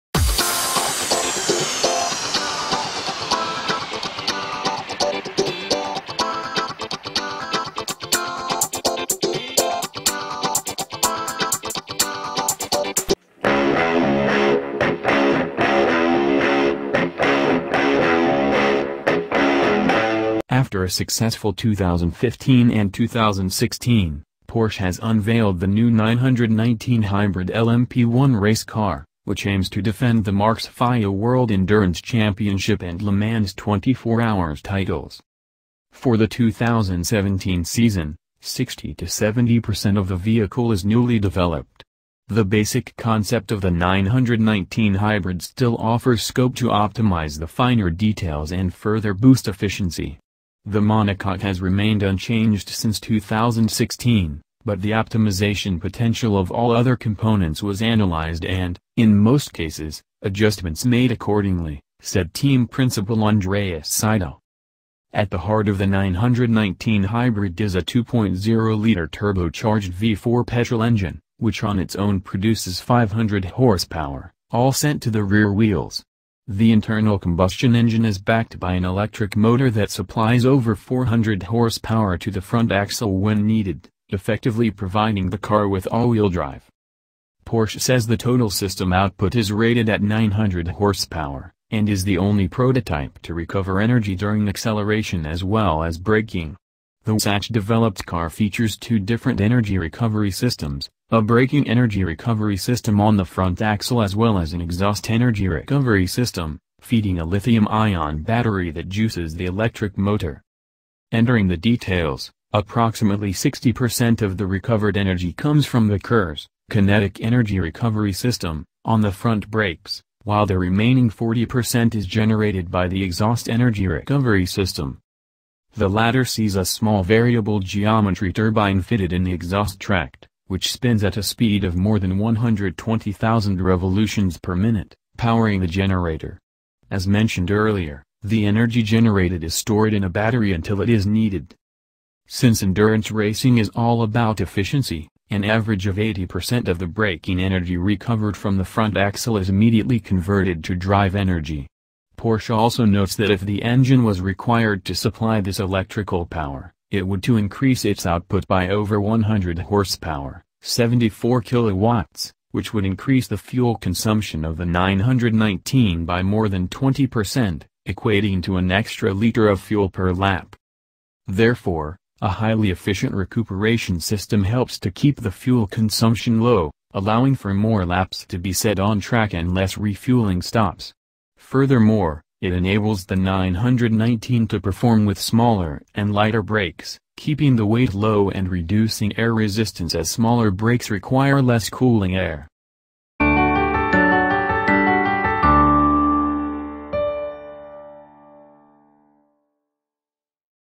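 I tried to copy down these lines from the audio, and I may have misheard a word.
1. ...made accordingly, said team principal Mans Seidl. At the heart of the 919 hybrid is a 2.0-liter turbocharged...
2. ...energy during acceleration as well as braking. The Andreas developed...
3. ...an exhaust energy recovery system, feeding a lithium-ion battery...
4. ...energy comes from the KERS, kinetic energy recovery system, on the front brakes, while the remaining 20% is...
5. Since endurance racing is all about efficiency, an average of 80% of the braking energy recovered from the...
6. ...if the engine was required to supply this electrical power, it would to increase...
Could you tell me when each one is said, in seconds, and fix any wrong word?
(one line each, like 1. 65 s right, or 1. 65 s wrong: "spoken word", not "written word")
1. 60 s wrong: "Andreas", not "Mans"
2. 93 s wrong: "Satch", not "Andreas"
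3. 104 s right
4. 114 s wrong: "40", not "20"
5. 142 s right
6. 153 s right.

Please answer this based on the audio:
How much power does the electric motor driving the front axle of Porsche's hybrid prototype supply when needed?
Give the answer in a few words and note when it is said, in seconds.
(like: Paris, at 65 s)
Over 400 horsepower, at 80 s.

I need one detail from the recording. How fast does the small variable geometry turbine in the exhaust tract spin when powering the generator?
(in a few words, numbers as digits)
More than 120,000 rpm.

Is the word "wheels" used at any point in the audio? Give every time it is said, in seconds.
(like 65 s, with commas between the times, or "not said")
75 s, 85 s.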